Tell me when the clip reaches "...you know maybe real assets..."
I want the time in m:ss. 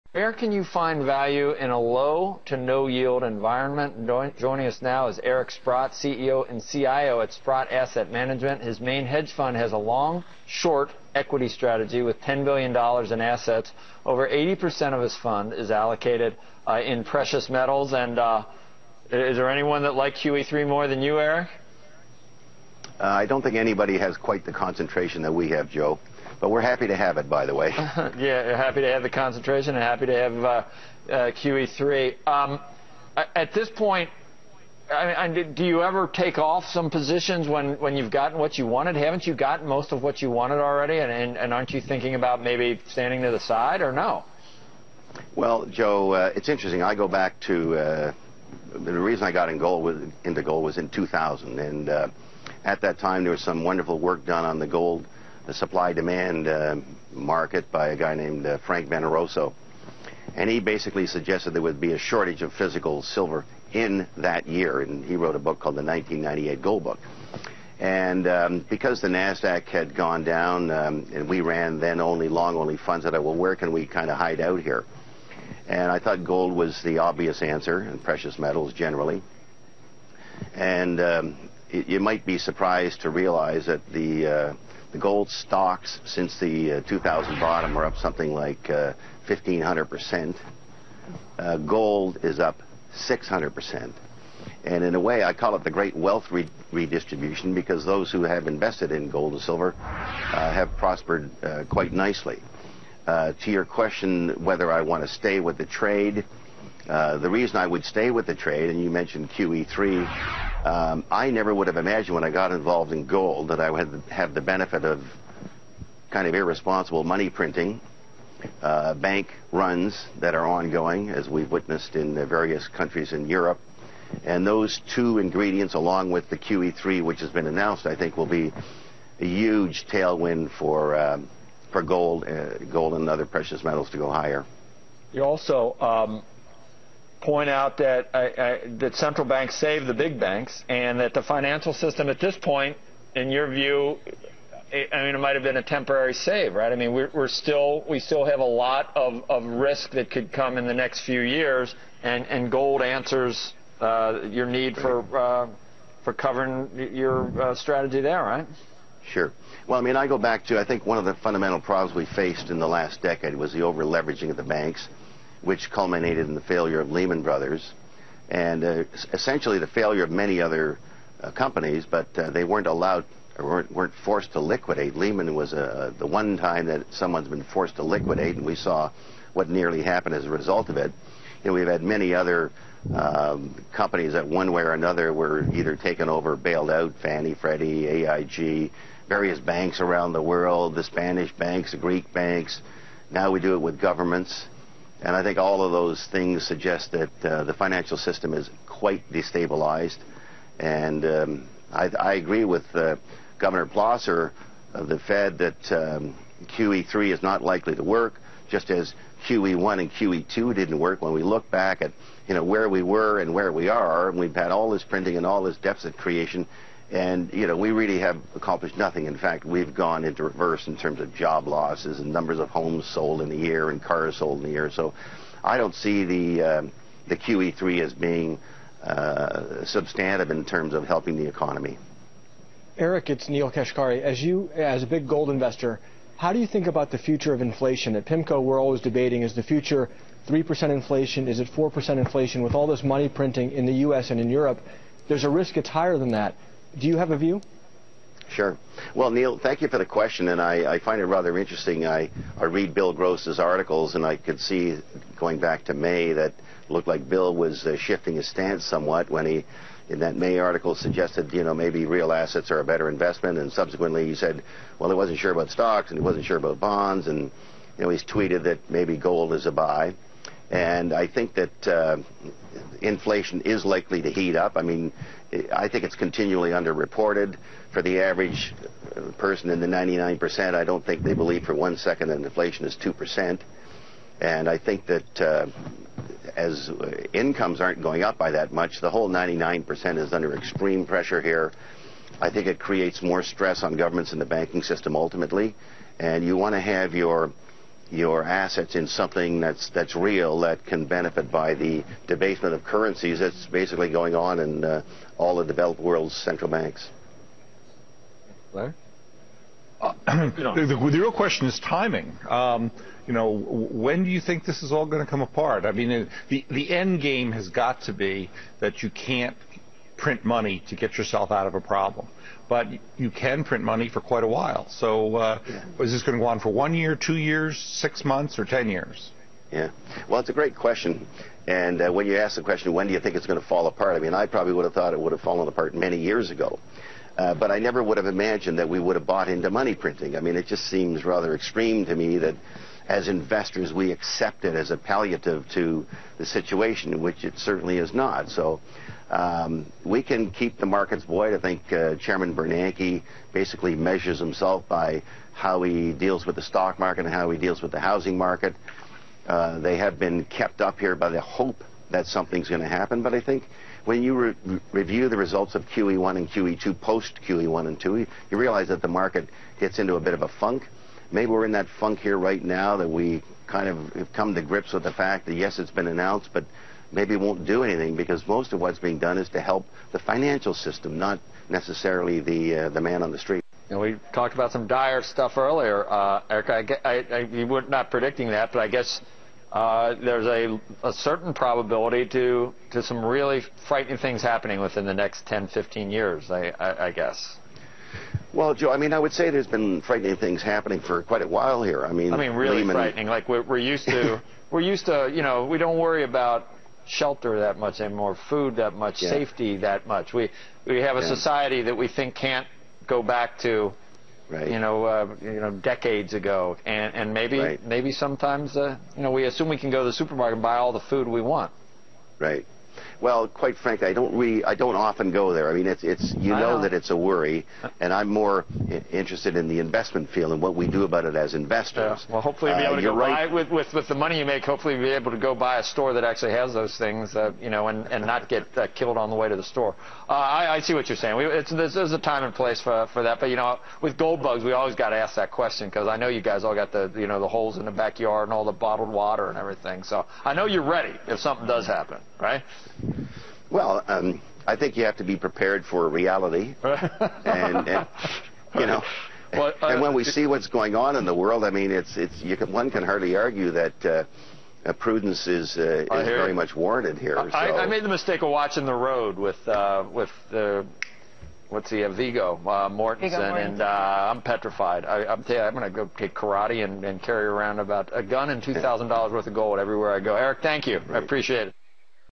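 4:21.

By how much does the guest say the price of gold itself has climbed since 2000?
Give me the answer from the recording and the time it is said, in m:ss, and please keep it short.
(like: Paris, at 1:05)
600%, at 1:32.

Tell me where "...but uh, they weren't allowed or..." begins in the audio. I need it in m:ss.
2:51.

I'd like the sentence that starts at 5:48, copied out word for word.
So um, we can keep the markets void.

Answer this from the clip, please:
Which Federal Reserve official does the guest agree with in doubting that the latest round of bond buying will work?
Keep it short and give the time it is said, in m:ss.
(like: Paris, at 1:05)
Governor Plosser, at 3:23.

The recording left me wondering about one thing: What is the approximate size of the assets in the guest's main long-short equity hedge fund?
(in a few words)
$10 billion.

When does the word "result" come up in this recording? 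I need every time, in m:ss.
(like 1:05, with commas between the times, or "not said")
3:00, 6:05.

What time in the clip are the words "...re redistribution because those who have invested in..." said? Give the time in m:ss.
1:36.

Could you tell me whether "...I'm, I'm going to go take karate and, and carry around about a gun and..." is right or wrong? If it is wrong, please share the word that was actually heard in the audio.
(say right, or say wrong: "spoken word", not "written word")
right.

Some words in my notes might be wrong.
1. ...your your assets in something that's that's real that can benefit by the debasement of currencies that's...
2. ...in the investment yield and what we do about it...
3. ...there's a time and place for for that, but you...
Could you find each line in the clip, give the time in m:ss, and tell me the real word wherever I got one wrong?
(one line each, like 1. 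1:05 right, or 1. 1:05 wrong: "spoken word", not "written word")
1. 4:56 right
2. 7:09 wrong: "field", not "yield"
3. 7:21 right.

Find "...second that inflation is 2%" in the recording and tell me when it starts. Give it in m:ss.
4:41.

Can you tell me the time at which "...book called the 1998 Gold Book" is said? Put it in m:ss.
1:05.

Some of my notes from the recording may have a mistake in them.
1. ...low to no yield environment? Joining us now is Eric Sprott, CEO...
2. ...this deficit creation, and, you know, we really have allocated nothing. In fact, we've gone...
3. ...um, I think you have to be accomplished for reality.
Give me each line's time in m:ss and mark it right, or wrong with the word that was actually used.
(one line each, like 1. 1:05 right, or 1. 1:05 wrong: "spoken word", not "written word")
1. 0:01 right
2. 3:35 wrong: "accomplished", not "allocated"
3. 7:33 wrong: "prepared", not "accomplished".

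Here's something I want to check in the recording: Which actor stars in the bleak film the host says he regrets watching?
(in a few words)
Viggo Mortensen.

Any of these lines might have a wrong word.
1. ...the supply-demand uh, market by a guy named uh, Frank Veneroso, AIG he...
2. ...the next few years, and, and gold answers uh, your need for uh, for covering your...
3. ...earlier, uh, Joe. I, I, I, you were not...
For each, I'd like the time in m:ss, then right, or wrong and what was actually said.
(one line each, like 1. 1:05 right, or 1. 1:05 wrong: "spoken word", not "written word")
1. 0:55 wrong: "And", not "AIG"
2. 2:30 right
3. 6:25 wrong: "Eric", not "Joe".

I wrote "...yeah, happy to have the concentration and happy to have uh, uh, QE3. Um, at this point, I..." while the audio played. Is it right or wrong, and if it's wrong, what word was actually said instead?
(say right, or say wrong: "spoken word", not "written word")
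right.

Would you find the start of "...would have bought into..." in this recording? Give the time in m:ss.
5:38.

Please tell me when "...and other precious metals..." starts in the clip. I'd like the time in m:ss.
2:12.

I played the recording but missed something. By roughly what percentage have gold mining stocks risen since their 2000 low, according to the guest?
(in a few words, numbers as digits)
1,500%.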